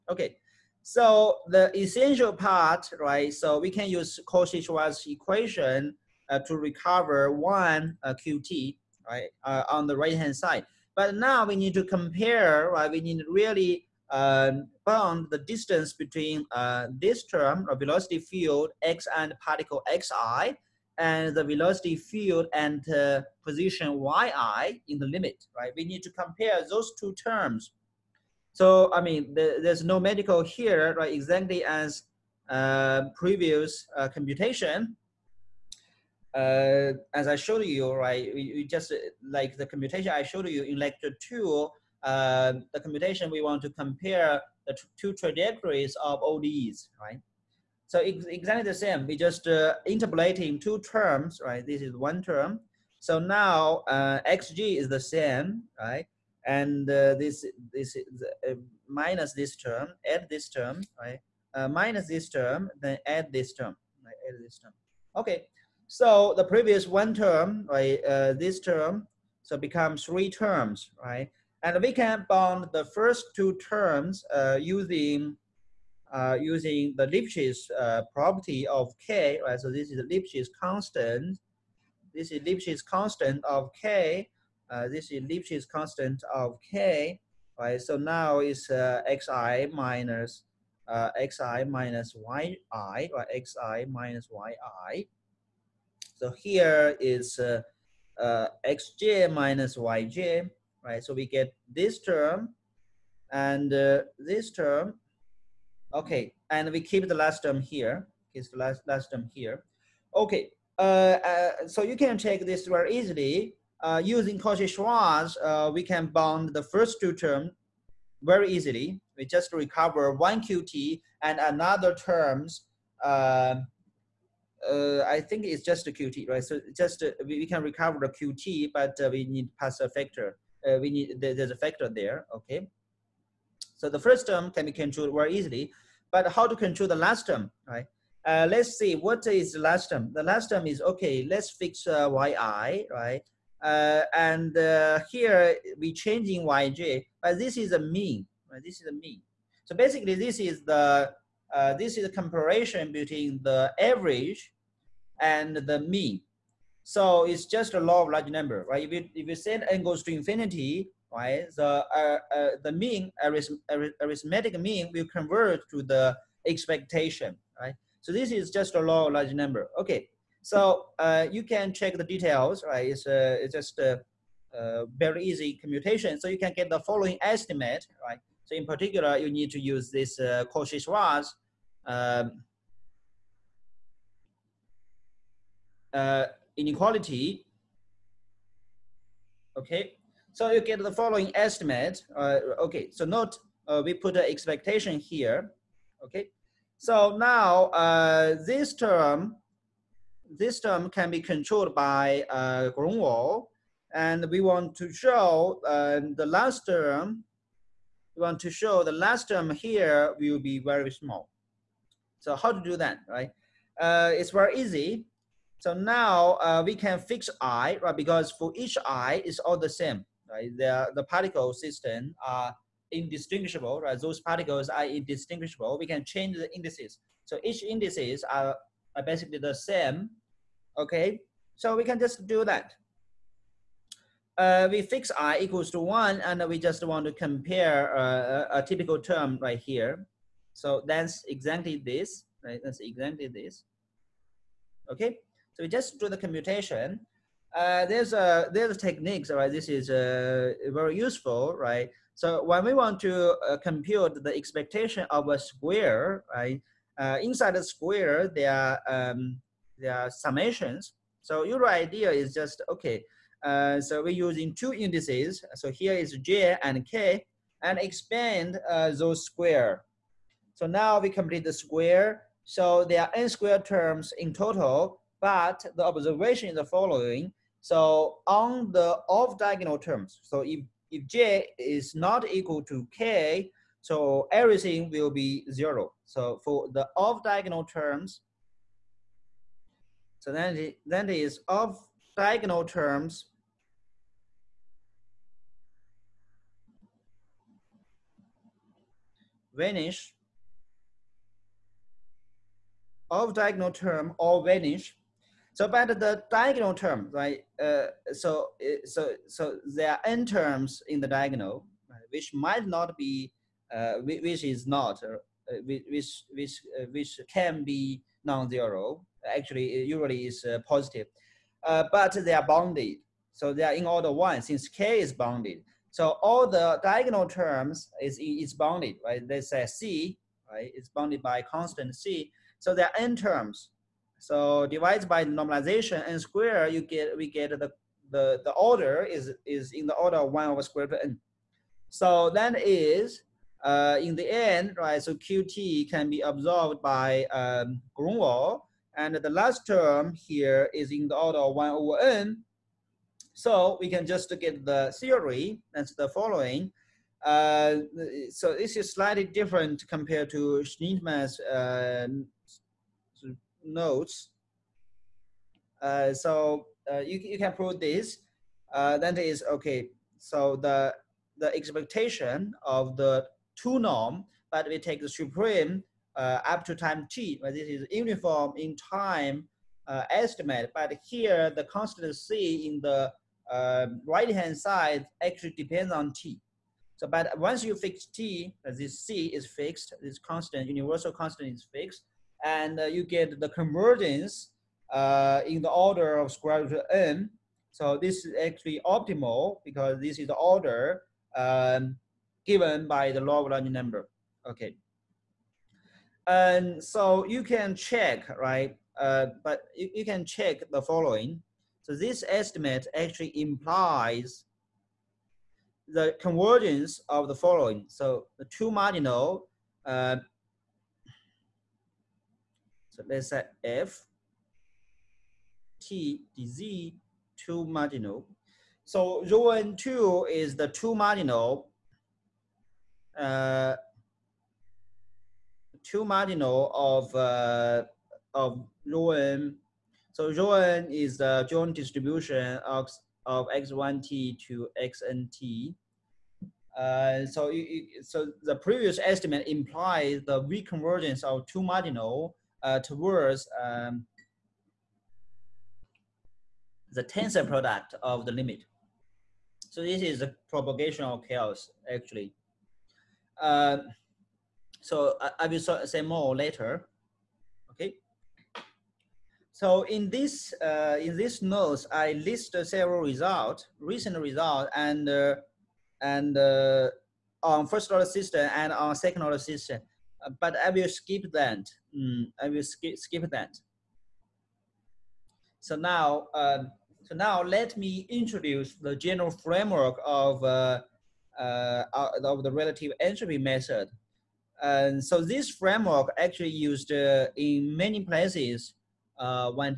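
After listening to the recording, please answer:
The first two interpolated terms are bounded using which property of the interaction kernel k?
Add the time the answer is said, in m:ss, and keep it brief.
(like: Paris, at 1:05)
Lipschitz property, at 1:17.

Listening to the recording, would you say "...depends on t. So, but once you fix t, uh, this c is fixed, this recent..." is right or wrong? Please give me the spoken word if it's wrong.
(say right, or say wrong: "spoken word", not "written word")
wrong: "constant", not "recent".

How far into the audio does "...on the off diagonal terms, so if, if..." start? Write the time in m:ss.
4:38.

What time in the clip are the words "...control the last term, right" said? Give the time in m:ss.
2:16.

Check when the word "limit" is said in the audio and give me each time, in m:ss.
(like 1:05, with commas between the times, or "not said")
0:25, 7:38.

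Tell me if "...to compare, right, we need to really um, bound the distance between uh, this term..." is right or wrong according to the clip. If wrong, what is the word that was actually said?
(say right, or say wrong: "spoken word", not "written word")
right.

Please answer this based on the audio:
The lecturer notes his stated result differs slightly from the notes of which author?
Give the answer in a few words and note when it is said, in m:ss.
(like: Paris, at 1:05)
Sznitman, at 6:00.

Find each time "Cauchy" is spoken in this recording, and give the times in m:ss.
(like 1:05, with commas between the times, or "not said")
0:04, 1:54, 3:00.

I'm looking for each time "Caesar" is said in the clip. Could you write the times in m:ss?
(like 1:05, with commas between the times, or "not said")
not said.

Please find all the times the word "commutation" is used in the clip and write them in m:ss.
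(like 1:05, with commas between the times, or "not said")
2:55, 4:06.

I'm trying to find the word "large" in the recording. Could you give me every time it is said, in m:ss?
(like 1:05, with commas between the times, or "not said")
2:38, 2:49, 6:43.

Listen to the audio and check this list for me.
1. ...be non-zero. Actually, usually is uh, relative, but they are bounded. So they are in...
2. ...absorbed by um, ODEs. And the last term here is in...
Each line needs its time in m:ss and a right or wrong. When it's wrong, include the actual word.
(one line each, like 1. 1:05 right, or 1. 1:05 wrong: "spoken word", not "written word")
1. 5:17 wrong: "positive", not "relative"
2. 5:46 wrong: "Gronwall", not "ODEs".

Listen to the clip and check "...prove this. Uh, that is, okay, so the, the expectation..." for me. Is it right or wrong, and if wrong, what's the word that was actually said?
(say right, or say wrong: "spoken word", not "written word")
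right.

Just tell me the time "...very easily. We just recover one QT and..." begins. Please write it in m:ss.
1:58.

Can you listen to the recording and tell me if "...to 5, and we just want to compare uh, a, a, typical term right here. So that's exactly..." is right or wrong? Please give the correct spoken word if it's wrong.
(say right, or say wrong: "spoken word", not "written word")
wrong: "1", not "5".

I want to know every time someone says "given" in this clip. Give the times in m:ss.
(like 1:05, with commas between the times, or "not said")
6:42.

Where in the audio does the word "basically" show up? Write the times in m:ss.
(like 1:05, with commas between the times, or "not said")
2:29, 3:49.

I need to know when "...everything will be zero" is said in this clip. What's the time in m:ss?
4:44.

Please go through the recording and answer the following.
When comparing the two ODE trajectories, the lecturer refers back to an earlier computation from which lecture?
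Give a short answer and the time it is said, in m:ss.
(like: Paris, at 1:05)
lecture two, at 0:40.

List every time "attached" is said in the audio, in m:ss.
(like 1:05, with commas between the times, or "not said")
not said.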